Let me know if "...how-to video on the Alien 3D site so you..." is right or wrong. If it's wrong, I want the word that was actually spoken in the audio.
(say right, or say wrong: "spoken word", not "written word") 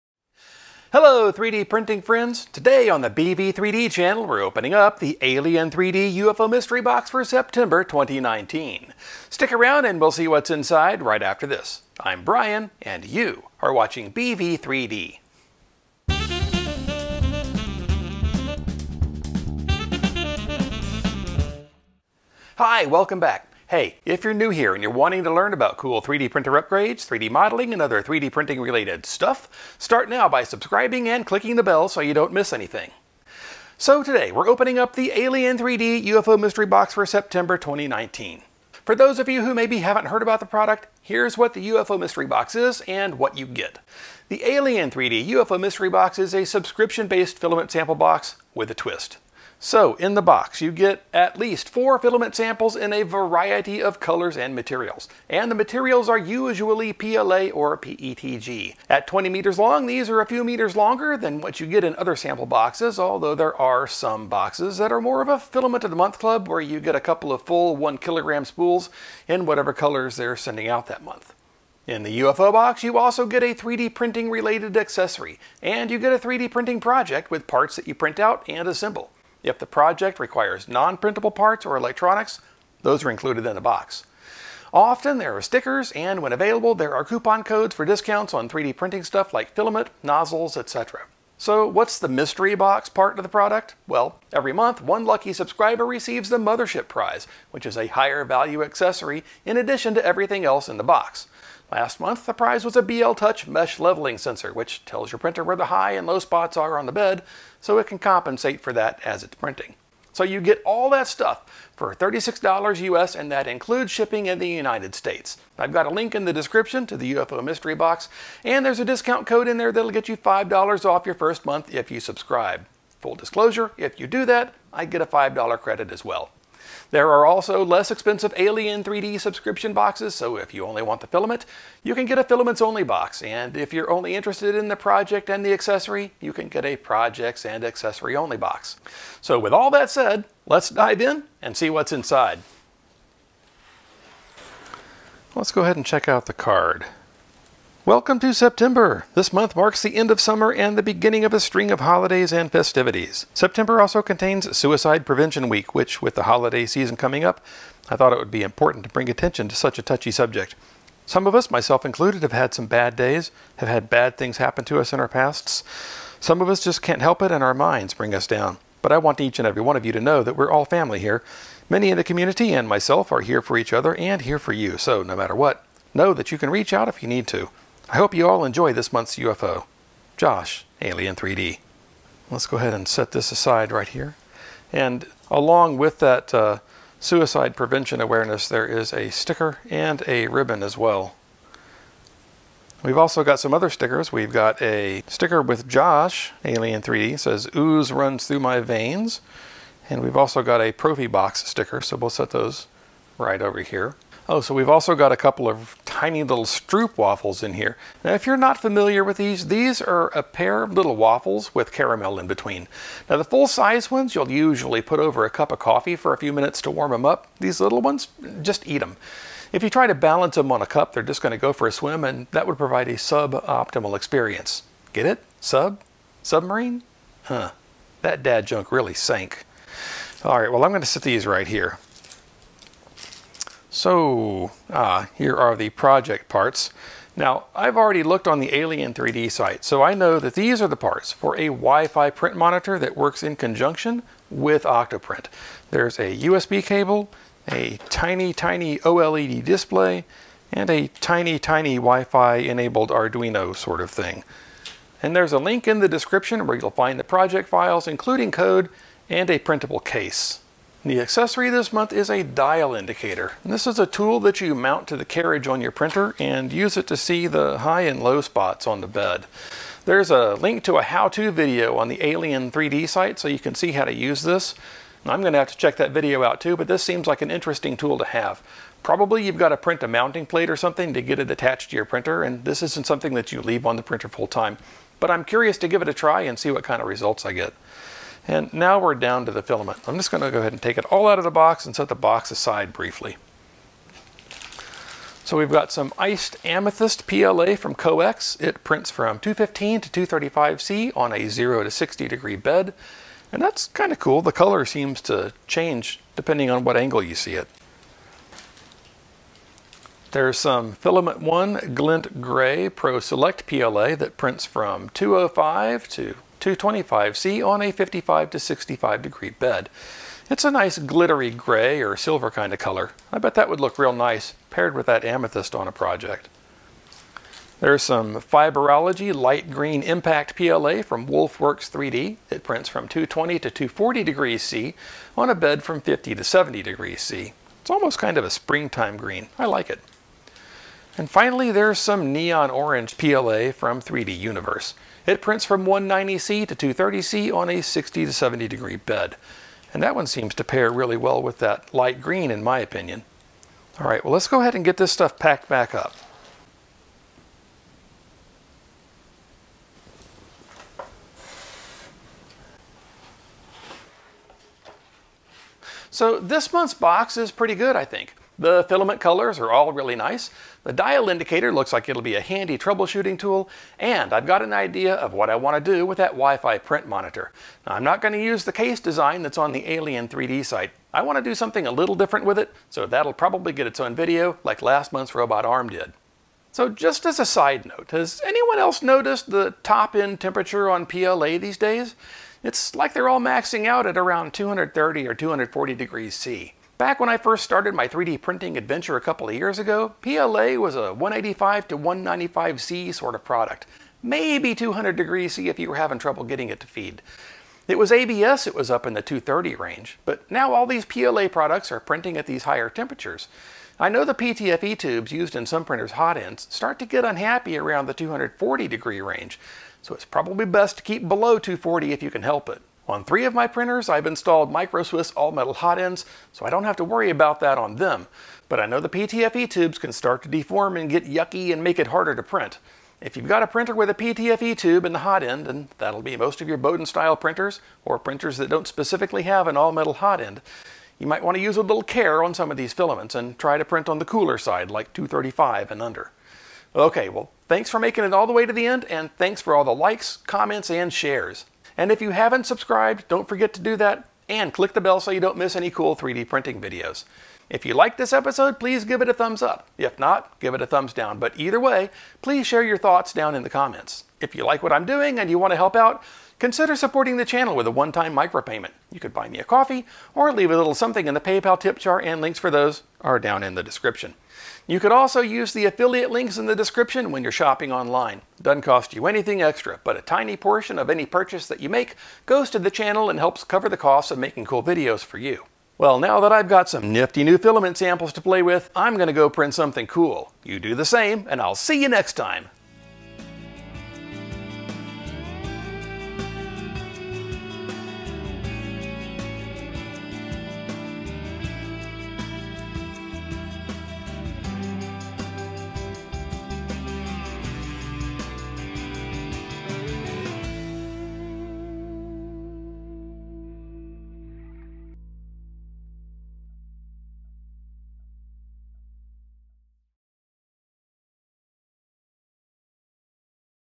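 right.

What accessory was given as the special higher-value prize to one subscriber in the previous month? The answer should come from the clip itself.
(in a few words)
BL Touch.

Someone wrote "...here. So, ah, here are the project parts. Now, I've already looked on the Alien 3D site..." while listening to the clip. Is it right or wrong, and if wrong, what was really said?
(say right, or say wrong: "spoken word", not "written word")
right.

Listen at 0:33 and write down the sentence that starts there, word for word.
So today, we're opening up the Alien 3D UFO Mystery Box for September 2019.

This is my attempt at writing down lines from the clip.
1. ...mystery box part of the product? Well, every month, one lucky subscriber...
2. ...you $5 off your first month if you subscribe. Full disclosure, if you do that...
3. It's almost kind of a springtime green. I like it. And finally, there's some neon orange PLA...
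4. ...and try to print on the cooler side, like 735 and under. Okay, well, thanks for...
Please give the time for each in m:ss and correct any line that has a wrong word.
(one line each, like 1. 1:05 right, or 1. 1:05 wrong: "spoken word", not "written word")
1. 1:32 right
2. 2:00 right
3. 5:37 right
4. 7:23 wrong: "235", not "735".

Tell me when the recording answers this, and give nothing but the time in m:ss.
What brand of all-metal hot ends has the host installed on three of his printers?
7:04.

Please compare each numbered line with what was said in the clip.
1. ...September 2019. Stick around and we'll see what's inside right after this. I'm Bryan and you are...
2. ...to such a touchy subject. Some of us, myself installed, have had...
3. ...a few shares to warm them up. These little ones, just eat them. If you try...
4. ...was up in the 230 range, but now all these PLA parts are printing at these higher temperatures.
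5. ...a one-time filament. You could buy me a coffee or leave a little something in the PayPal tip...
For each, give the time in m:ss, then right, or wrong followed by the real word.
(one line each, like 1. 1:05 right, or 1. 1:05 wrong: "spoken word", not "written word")
1. 0:07 right
2. 2:39 wrong: "included", not "installed"
3. 3:36 wrong: "minutes", not "shares"
4. 6:48 wrong: "products", not "parts"
5. 7:47 wrong: "micropayment", not "filament".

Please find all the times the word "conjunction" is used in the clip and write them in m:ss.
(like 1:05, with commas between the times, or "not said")
4:03.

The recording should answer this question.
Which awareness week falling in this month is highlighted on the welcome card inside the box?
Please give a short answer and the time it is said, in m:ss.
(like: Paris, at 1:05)
Suicide Prevention Week, at 2:34.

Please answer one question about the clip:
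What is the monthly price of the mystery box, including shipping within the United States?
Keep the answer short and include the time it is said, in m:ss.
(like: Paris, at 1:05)
$36, at 1:51.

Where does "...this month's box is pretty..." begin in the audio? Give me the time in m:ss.
6:06.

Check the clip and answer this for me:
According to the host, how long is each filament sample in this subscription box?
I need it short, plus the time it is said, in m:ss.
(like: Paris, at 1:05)
20 meters, at 0:59.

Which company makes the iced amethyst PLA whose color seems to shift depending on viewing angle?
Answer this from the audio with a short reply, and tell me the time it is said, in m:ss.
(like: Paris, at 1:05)
Coex, at 4:57.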